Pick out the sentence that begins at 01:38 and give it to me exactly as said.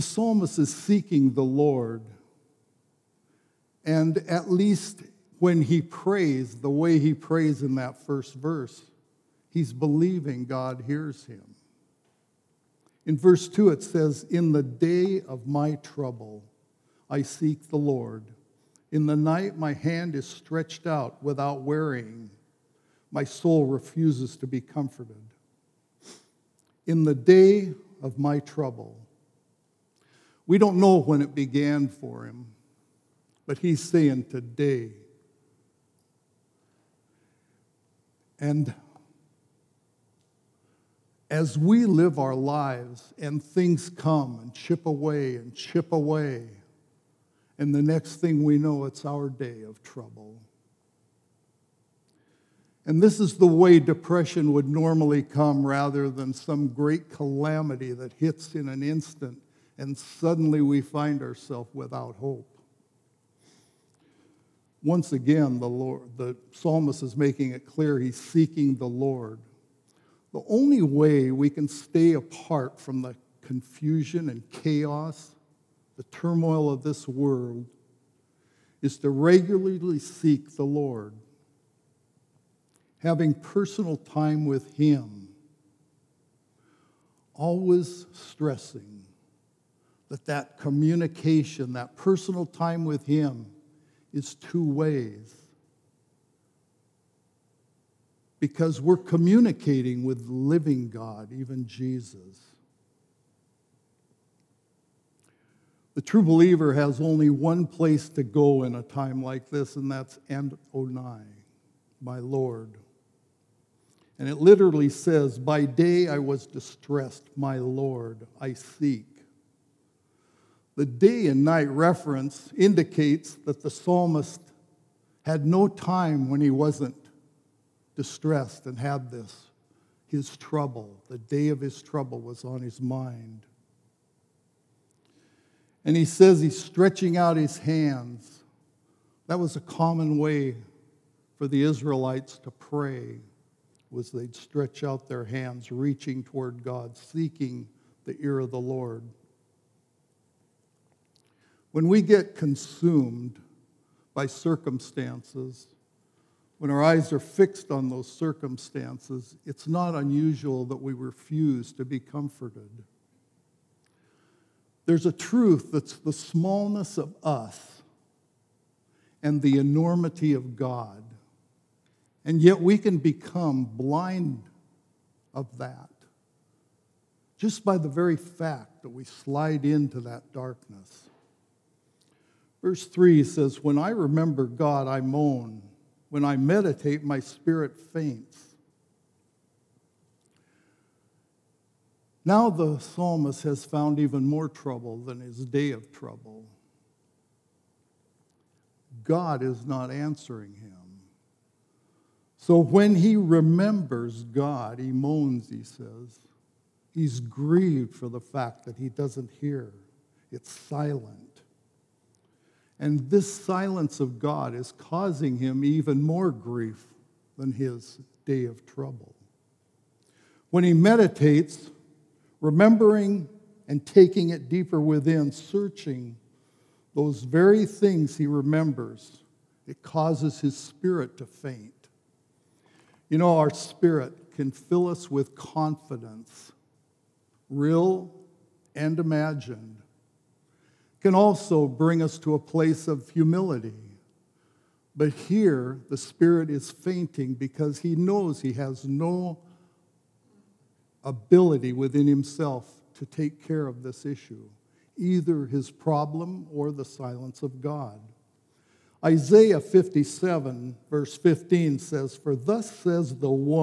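Because we're communicating with living God, even Jesus.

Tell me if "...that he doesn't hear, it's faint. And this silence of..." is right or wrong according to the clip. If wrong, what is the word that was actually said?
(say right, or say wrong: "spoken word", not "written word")
wrong: "silent", not "faint".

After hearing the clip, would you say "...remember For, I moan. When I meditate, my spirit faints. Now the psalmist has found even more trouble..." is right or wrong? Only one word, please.
wrong.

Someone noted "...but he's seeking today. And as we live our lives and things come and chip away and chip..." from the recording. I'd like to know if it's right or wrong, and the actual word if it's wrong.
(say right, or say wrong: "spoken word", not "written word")
wrong: "saying", not "seeking".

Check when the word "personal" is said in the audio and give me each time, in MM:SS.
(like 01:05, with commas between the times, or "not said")
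01:23, 01:31.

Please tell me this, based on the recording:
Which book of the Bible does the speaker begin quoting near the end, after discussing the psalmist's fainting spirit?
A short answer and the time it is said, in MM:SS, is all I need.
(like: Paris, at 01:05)
Isaiah, at 04:19.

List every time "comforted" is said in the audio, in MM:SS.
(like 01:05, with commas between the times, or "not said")
00:24, 02:41.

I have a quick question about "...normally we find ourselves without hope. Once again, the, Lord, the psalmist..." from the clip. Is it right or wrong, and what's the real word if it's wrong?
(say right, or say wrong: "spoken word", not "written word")
wrong: "suddenly", not "normally".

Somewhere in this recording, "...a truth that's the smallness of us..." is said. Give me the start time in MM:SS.
02:45.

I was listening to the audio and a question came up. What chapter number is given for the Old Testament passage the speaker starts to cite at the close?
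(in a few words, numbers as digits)
57.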